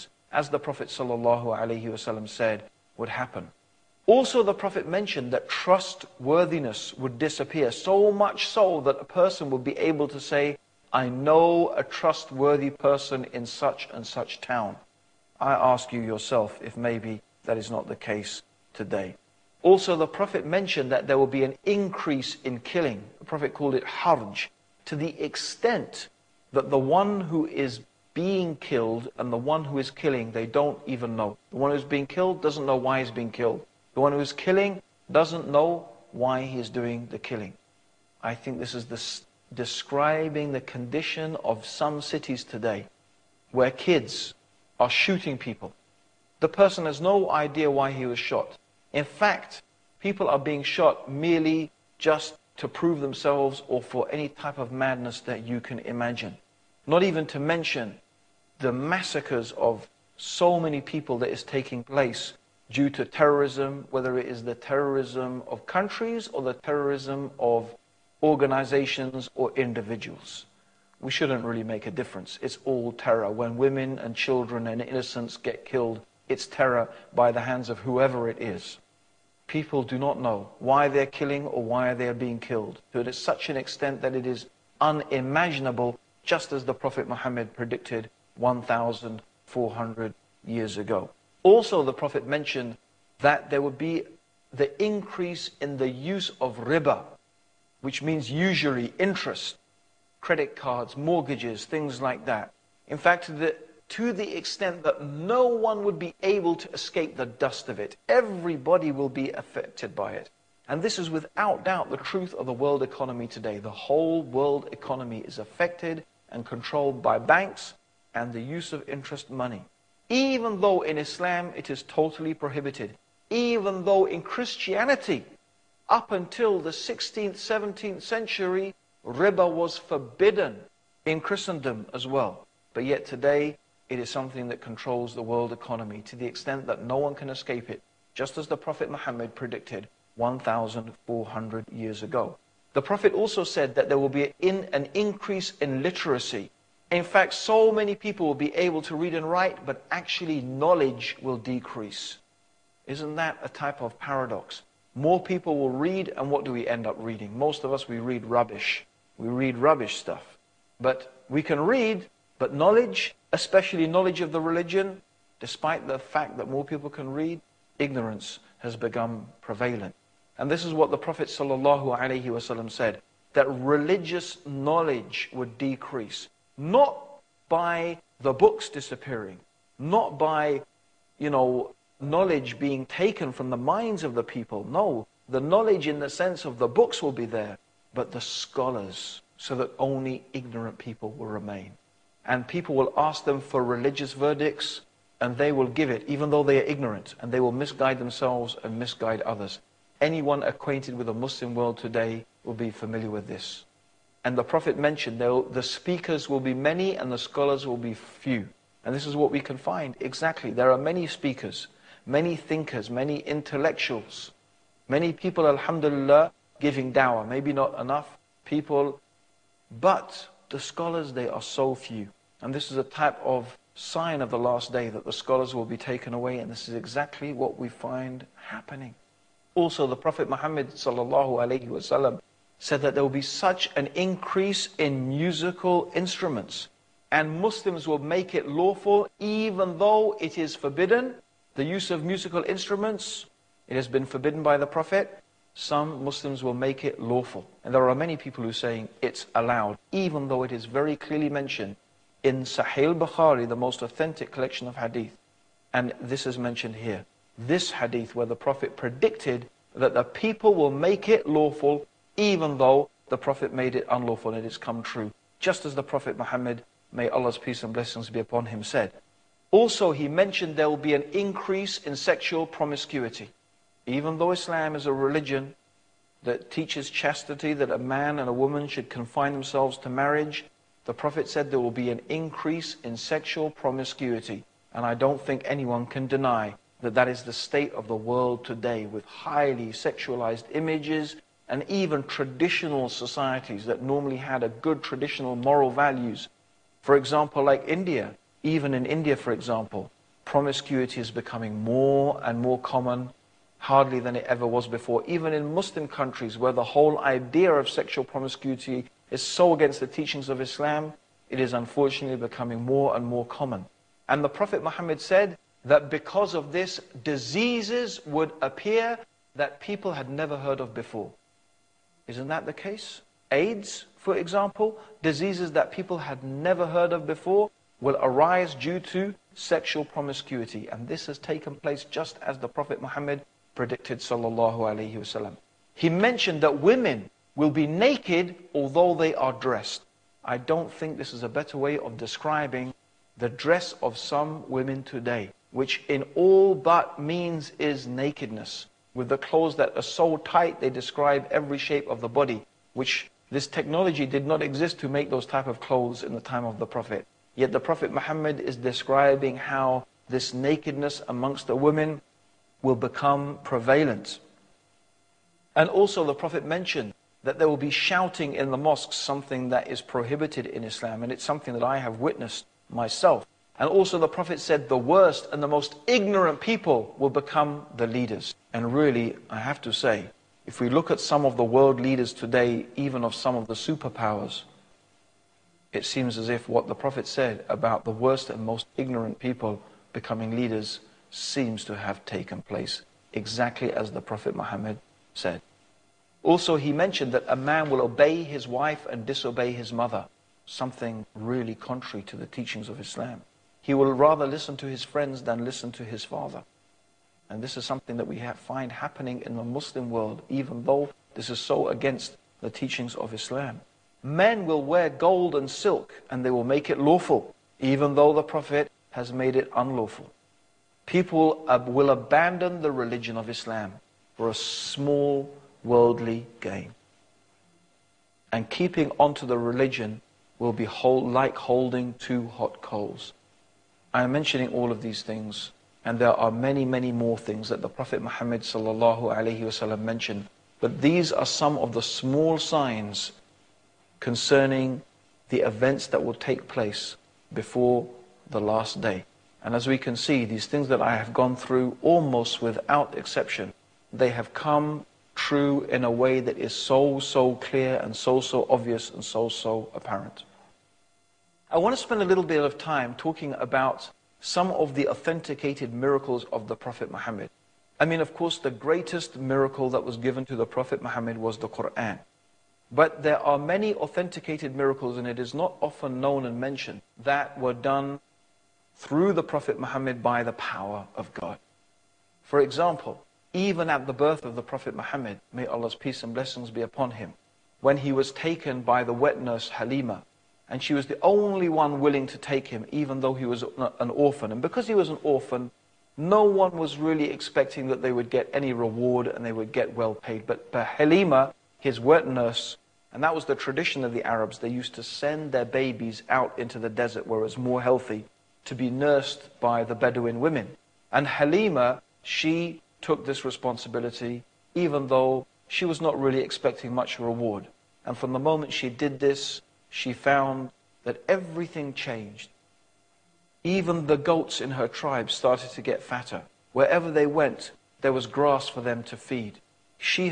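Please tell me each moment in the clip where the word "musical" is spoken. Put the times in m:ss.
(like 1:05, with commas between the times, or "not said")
3:55, 4:02.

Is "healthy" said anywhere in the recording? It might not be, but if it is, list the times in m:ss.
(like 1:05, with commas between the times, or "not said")
8:27.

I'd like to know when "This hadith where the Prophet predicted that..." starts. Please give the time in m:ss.
4:17.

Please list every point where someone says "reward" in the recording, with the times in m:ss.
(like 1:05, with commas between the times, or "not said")
8:18, 8:36.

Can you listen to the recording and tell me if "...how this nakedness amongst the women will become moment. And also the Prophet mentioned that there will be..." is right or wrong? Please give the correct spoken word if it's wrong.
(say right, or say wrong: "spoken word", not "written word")
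wrong: "prevalent", not "moment".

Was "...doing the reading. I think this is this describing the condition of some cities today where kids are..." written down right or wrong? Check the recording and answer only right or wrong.
wrong.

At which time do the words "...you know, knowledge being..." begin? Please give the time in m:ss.
3:01.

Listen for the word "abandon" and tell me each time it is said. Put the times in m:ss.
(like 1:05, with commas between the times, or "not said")
7:01.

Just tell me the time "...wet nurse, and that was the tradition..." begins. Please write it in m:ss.
8:21.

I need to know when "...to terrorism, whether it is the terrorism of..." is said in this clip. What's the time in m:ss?
1:02.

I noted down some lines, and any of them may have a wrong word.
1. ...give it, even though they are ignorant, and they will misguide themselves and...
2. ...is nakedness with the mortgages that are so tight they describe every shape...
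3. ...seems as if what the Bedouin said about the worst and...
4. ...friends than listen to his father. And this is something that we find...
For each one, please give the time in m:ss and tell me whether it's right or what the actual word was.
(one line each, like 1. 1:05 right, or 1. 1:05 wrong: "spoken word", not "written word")
1. 3:15 right
2. 5:47 wrong: "clothes", not "mortgages"
3. 6:25 wrong: "Prophet", not "Bedouin"
4. 6:44 right.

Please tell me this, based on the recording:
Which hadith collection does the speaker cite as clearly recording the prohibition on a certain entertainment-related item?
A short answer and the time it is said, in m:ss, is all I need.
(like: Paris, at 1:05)
Sahih Bukhari, at 4:12.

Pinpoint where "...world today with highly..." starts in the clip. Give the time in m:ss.
4:47.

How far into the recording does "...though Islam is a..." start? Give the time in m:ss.
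4:34.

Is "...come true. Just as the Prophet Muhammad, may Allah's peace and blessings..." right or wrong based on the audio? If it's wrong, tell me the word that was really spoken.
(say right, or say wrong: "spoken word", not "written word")
right.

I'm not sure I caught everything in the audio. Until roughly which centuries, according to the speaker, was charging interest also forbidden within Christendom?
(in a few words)
16th, 17th century.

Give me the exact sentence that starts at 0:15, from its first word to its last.
I ask you yourself if maybe that is not the case today.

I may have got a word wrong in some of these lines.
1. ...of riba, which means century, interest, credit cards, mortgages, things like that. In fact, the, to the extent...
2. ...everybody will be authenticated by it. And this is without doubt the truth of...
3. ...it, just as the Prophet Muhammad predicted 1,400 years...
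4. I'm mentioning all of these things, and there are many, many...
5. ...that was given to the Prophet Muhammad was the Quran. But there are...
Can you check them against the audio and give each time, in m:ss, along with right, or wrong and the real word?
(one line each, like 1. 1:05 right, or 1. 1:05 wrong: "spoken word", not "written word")
1. 1:36 wrong: "usury", not "century"
2. 1:48 wrong: "affected", not "authenticated"
3. 2:17 right
4. 7:13 right
5. 7:49 right.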